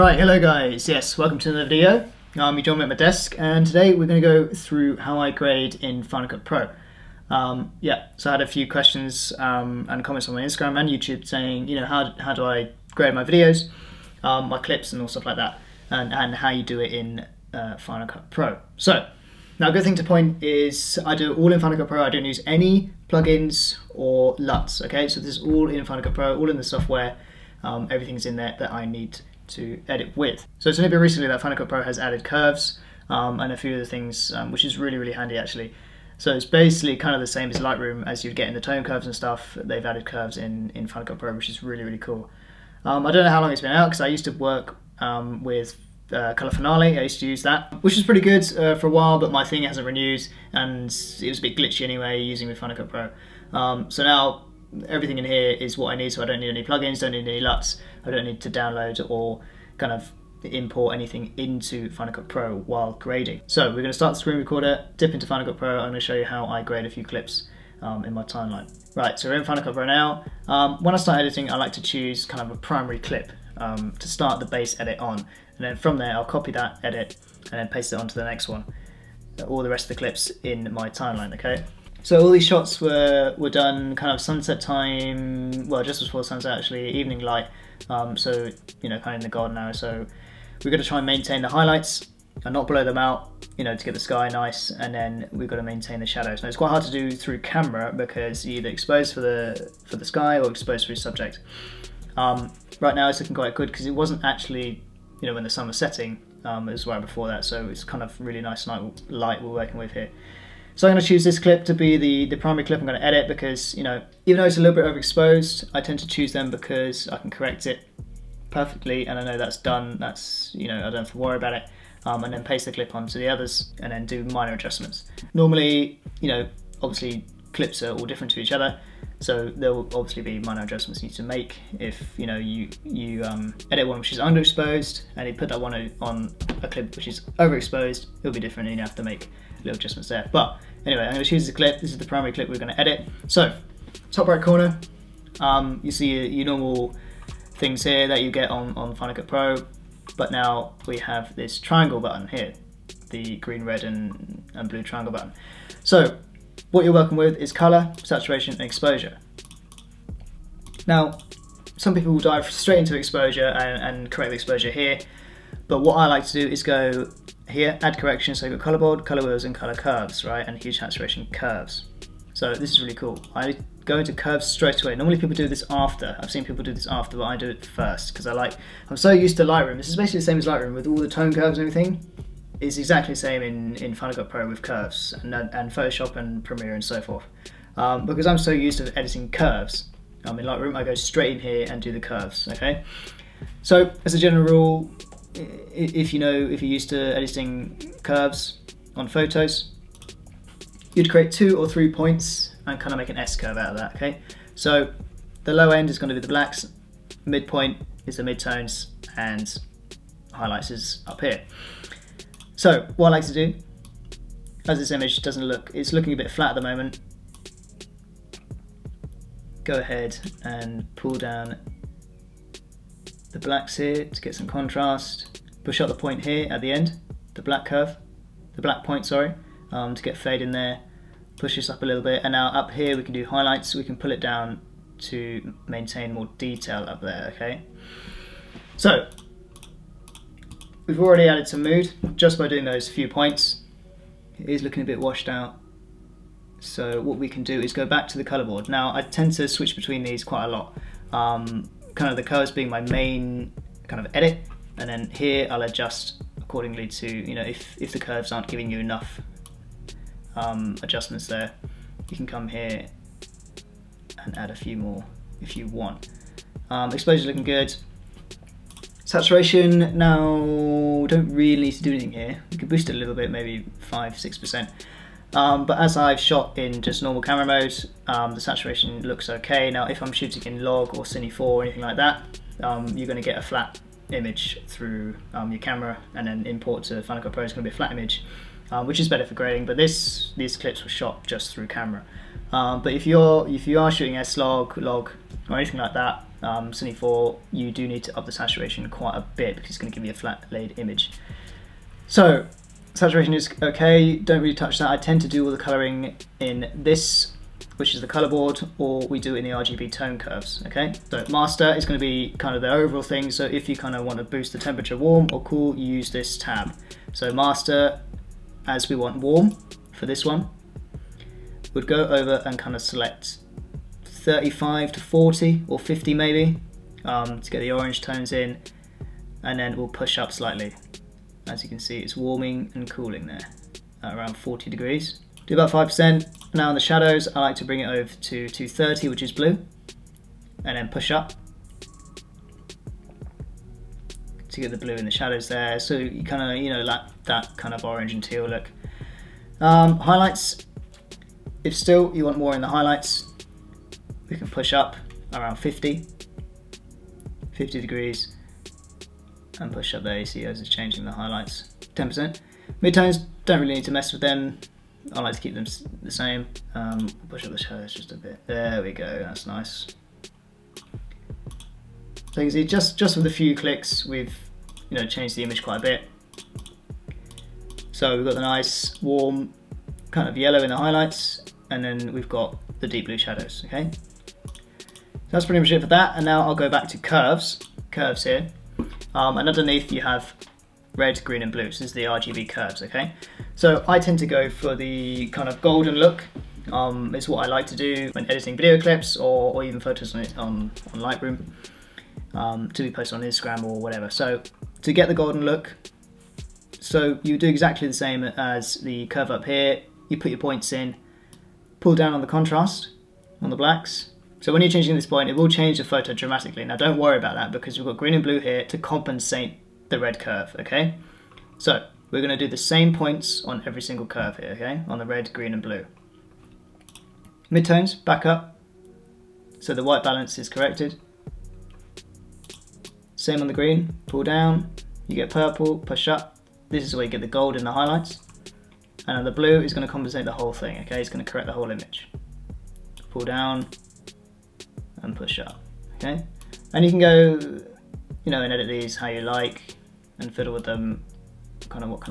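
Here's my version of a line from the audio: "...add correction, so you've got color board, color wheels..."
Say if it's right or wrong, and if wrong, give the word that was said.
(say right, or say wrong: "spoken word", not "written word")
right.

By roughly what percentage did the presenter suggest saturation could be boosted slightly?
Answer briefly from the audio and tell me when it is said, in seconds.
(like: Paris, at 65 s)
5 or 6%, at 273 s.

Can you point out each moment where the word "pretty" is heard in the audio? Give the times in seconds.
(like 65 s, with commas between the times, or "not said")
48 s, 385 s.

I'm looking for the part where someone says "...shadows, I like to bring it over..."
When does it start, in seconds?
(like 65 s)
336 s.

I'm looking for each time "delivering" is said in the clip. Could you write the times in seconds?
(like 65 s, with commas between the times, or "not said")
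not said.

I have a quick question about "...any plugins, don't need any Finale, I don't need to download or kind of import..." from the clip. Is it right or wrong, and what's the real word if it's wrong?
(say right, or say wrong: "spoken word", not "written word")
wrong: "LUTs", not "Finale".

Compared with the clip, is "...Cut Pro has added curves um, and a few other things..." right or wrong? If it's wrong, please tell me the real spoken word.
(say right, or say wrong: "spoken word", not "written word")
right.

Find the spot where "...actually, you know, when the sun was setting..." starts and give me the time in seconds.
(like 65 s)
104 s.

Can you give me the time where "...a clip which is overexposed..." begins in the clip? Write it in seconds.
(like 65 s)
136 s.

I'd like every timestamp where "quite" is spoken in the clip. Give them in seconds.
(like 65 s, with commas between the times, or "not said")
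96 s, 103 s, 250 s, 298 s, 375 s.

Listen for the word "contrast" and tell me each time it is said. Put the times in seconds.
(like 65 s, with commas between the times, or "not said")
224 s, 412 s.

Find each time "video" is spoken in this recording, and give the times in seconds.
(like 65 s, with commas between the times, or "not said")
1 s, 13 s, 398 s.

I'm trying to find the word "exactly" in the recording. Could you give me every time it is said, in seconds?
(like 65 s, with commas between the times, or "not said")
182 s, 407 s.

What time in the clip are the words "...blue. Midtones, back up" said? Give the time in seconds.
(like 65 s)
425 s.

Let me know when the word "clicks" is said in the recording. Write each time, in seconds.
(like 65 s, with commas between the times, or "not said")
373 s.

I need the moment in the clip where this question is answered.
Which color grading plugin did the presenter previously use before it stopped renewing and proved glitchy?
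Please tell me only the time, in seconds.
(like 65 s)
46 s.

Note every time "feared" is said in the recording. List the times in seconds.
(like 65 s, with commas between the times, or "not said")
not said.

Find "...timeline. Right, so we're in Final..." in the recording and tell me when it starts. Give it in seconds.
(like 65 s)
68 s.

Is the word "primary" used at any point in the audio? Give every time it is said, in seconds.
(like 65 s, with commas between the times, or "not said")
72 s, 112 s, 142 s.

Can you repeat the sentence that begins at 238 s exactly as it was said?
So, we've already added some mood just by doing those few points.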